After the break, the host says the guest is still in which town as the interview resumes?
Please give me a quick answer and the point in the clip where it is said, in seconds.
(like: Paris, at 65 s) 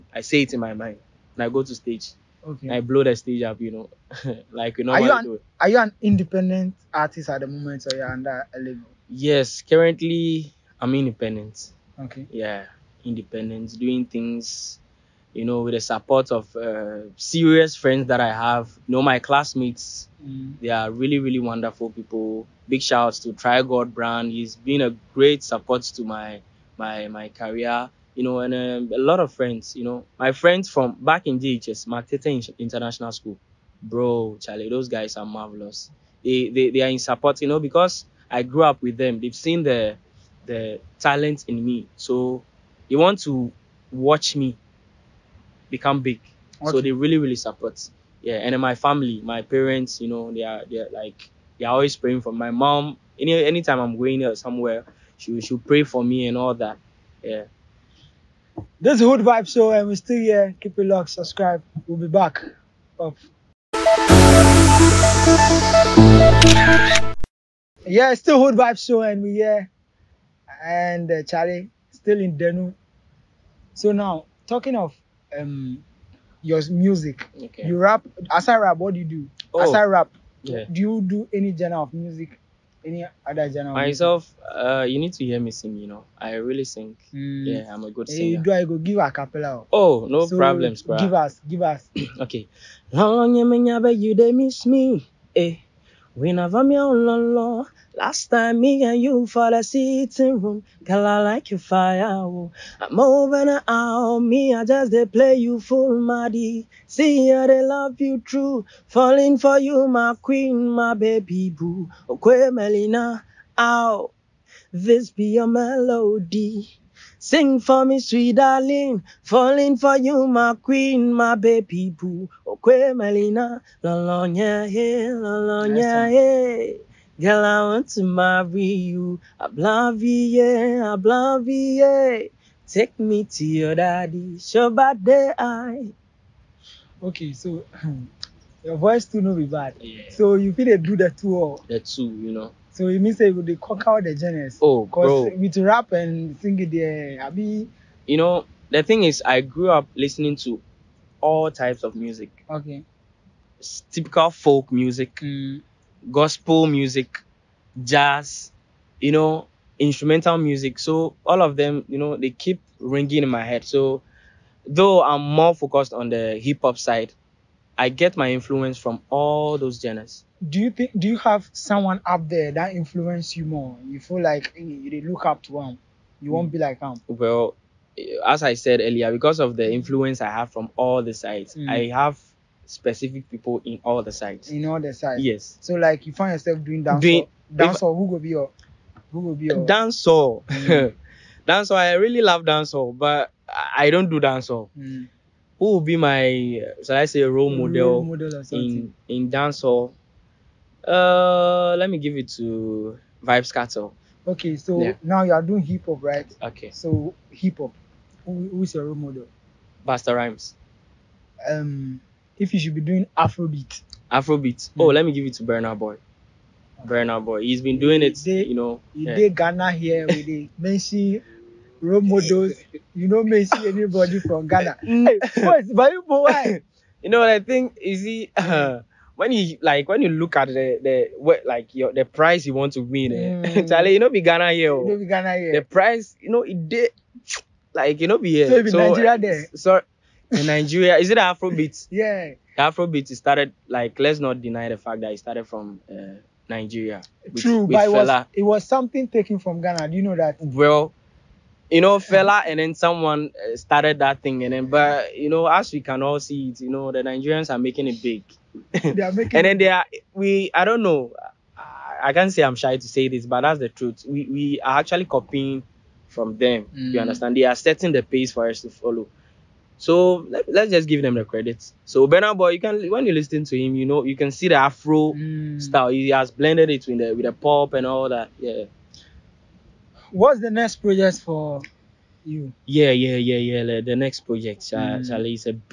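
Denu, at 72 s.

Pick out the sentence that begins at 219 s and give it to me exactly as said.
They Ghana here with the mention role models.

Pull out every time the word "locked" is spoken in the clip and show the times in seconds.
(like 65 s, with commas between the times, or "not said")
60 s.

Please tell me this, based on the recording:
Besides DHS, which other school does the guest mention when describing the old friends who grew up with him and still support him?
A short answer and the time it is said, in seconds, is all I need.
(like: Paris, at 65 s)
Makete International School, at 31 s.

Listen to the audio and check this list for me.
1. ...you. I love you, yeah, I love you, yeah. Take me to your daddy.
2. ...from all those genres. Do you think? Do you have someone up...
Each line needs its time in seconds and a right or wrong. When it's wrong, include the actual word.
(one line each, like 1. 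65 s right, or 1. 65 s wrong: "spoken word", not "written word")
1. 128 s right
2. 168 s right.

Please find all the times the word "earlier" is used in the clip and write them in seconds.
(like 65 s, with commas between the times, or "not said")
178 s.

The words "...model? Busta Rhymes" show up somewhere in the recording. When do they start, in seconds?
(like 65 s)
208 s.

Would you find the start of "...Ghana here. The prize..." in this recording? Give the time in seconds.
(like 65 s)
235 s.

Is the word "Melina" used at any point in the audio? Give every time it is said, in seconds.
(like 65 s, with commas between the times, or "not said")
112 s, 122 s.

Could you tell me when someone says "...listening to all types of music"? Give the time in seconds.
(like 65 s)
149 s.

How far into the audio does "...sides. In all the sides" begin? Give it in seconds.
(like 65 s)
184 s.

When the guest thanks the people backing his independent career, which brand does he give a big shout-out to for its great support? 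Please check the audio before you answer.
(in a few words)
Try God Brand.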